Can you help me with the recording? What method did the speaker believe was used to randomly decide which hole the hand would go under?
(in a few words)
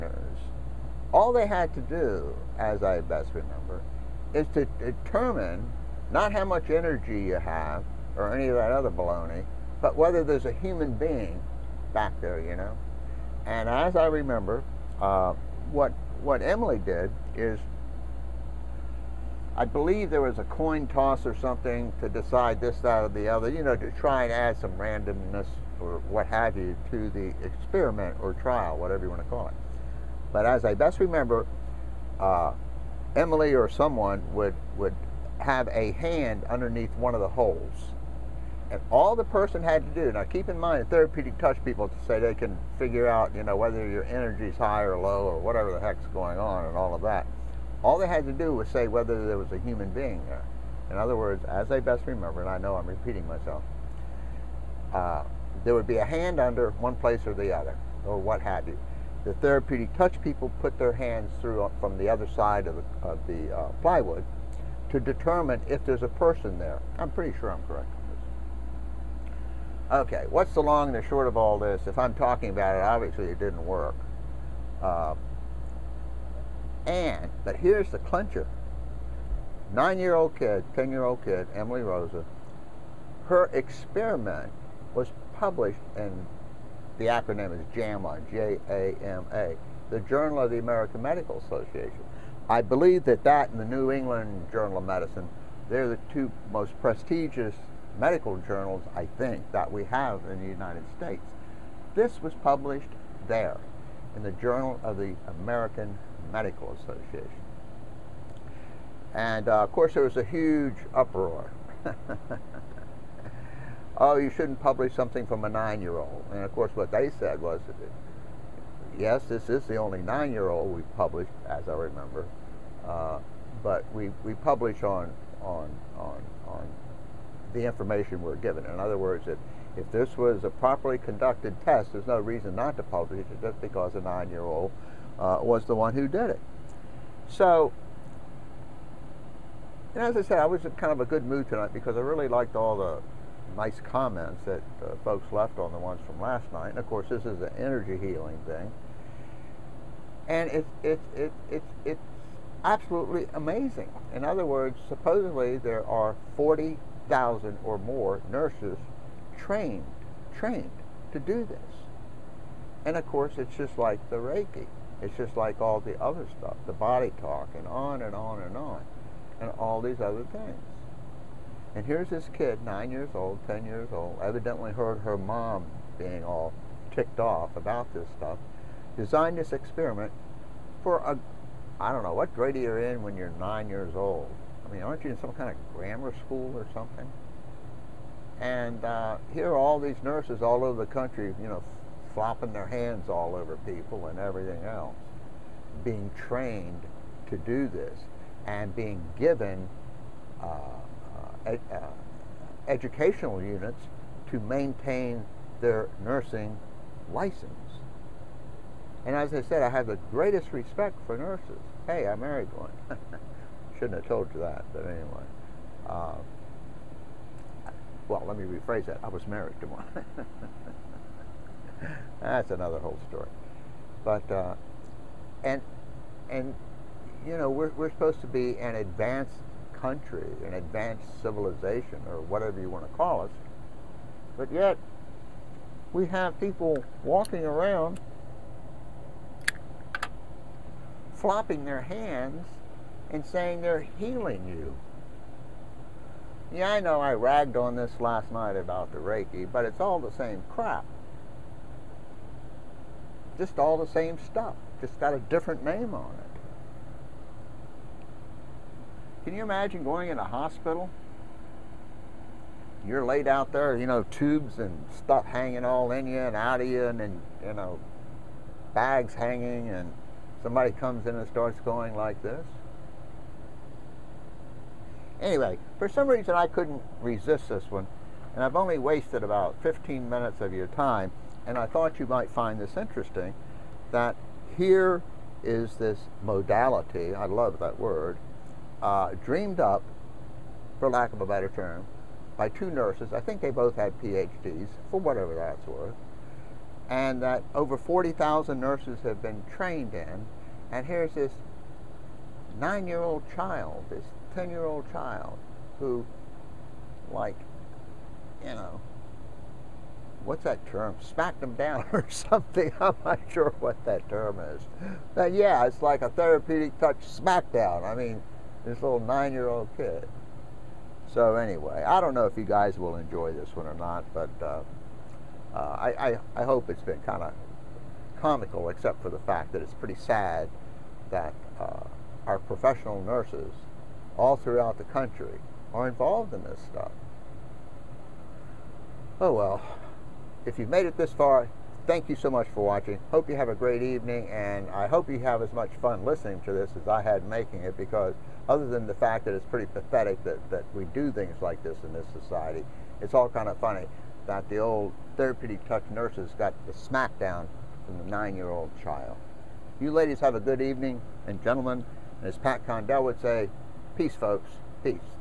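coin toss.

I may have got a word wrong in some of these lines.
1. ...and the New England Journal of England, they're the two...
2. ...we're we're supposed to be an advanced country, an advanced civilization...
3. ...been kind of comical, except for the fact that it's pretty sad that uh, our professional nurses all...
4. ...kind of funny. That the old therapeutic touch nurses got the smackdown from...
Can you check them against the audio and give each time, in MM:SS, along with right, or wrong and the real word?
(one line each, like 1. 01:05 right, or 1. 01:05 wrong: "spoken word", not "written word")
1. 01:33 wrong: "Medicine", not "England"
2. 03:47 right
3. 05:26 right
4. 05:53 right.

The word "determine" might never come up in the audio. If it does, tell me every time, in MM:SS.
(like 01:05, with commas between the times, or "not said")
00:04, 01:04.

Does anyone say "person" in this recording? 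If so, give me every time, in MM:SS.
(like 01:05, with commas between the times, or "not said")
00:39, 01:06.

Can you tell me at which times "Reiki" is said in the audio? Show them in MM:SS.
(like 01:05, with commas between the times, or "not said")
02:44, 04:08.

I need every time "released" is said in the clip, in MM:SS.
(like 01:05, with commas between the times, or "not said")
not said.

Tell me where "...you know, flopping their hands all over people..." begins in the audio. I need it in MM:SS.
03:11.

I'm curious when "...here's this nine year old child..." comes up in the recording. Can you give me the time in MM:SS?
05:00.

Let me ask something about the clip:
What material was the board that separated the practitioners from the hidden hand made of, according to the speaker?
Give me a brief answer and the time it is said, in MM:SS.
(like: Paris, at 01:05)
plywood, at 01:03.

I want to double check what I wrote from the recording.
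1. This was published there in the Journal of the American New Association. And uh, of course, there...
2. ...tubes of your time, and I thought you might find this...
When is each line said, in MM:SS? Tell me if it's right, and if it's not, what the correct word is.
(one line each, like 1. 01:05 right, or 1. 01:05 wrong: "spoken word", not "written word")
1. 01:41 wrong: "Medical", not "New"
2. 04:40 wrong: "minutes", not "tubes".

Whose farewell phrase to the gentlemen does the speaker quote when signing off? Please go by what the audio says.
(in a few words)
Pat Condell.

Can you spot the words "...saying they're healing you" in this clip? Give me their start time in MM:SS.
04:03.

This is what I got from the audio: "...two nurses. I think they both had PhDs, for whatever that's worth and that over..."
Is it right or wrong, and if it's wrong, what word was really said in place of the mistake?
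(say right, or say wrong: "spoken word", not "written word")
right.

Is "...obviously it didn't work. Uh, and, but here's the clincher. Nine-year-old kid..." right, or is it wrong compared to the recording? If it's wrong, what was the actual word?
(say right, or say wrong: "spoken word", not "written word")
right.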